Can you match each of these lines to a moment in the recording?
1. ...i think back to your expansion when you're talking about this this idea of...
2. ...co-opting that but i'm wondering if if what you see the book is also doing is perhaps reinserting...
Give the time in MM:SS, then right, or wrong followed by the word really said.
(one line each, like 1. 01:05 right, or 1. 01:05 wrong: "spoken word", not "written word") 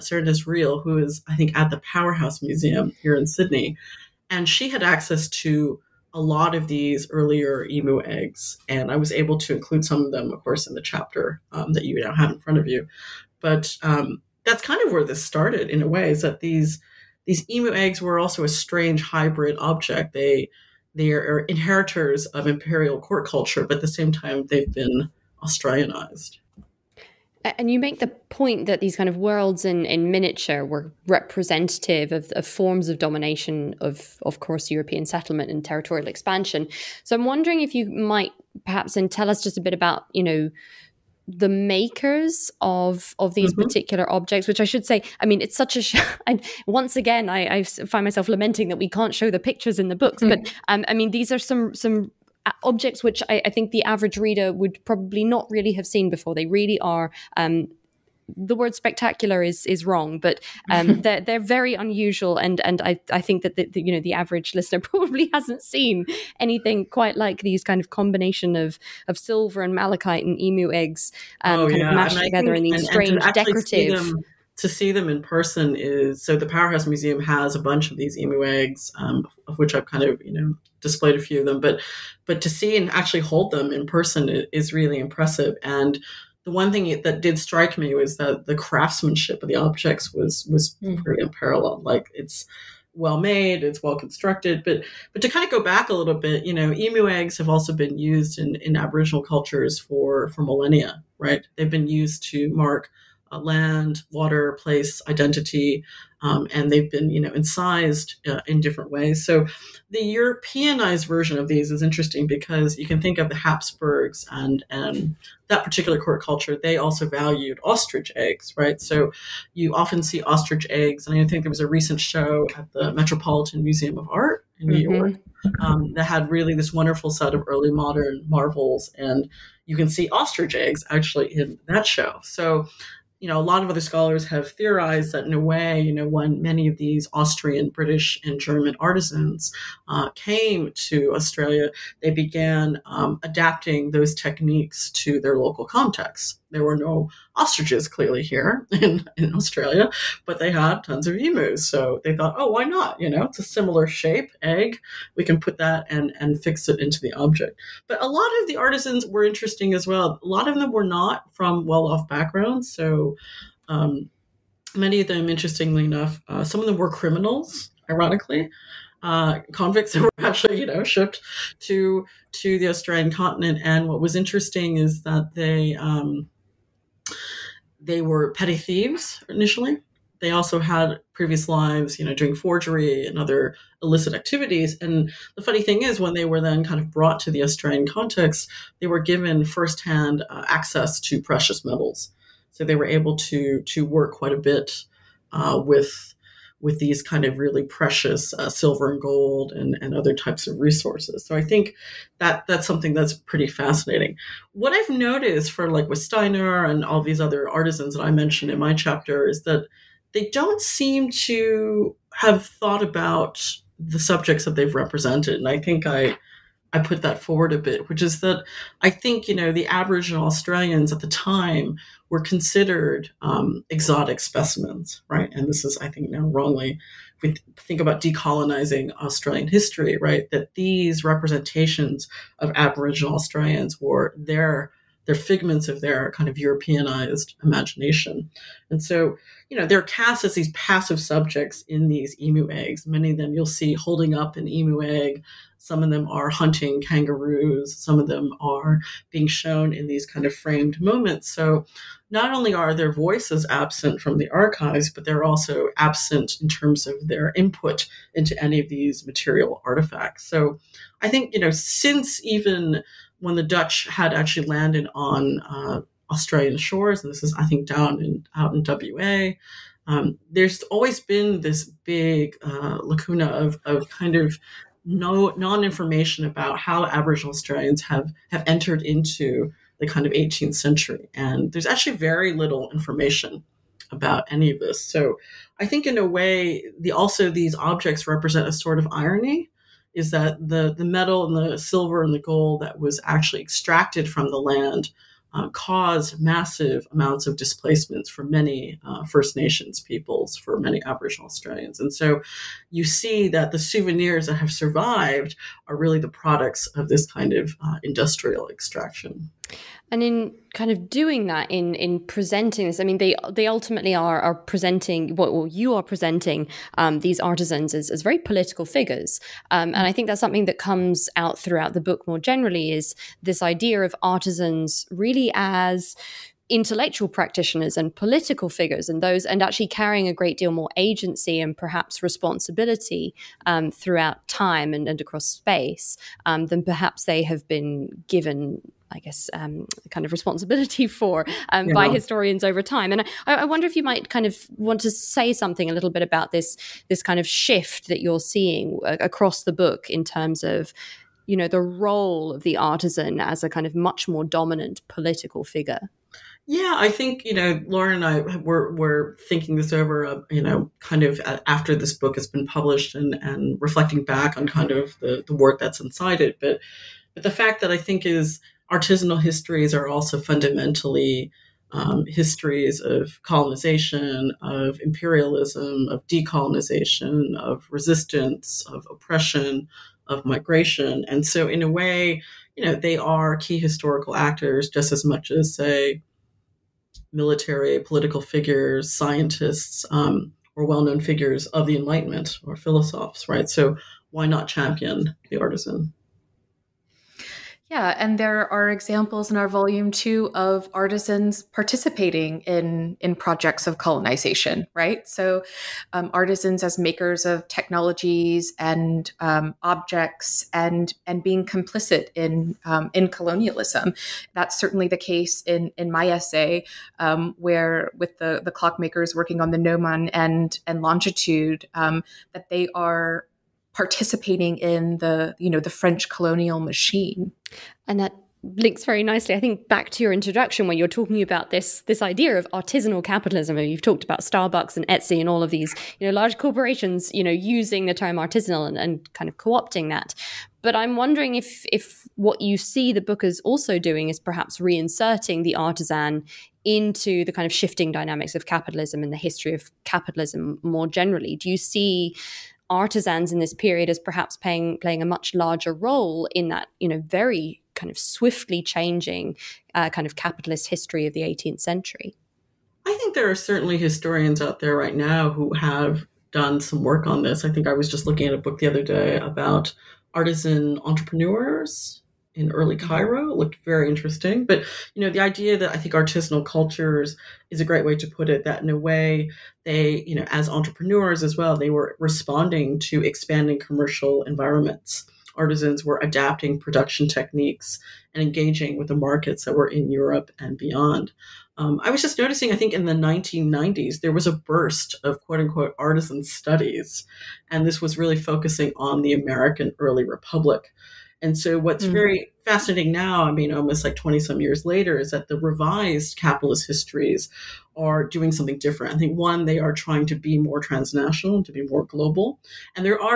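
1. 07:09 wrong: "introduction", not "expansion"
2. 07:19 right.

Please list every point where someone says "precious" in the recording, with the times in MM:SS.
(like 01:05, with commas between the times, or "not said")
03:11, 03:17.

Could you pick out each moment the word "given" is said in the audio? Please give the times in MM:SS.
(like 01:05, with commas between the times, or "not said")
03:08, 05:38.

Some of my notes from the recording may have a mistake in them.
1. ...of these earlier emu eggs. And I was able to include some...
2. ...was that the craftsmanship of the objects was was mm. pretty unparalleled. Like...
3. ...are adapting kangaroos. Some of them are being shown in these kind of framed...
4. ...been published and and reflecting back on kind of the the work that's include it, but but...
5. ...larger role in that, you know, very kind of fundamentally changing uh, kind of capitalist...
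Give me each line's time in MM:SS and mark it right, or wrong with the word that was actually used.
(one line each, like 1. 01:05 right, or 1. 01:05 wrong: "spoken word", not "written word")
1. 00:06 right
2. 01:27 right
3. 04:06 wrong: "hunting", not "adapting"
4. 06:02 wrong: "inside", not "include"
5. 07:35 wrong: "swiftly", not "fundamentally".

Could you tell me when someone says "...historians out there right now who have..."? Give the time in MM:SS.
07:43.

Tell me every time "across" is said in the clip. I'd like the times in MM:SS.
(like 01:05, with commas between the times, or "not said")
05:35, 05:48.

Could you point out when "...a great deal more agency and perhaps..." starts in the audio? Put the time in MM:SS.
05:30.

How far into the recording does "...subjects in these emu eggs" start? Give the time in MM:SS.
04:00.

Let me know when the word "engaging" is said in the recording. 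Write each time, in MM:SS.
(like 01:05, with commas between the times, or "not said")
08:08.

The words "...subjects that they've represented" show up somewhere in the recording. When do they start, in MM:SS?
03:33.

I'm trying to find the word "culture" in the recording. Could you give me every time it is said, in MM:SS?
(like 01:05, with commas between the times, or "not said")
00:23, 01:39, 01:56, 07:56.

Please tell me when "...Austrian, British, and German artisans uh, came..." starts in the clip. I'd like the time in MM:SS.
02:17.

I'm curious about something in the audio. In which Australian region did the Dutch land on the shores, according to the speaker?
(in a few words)
WA.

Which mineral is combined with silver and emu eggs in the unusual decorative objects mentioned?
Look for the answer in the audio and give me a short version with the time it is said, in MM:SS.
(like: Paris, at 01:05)
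malachite, at 01:09.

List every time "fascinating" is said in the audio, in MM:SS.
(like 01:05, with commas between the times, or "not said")
03:23, 08:22.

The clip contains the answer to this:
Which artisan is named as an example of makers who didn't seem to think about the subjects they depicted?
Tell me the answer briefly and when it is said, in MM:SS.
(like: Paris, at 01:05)
Steiner, at 03:26.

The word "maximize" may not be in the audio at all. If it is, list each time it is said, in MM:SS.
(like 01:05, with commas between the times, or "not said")
not said.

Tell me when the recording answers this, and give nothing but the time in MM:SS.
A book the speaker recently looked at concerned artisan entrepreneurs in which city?
07:52.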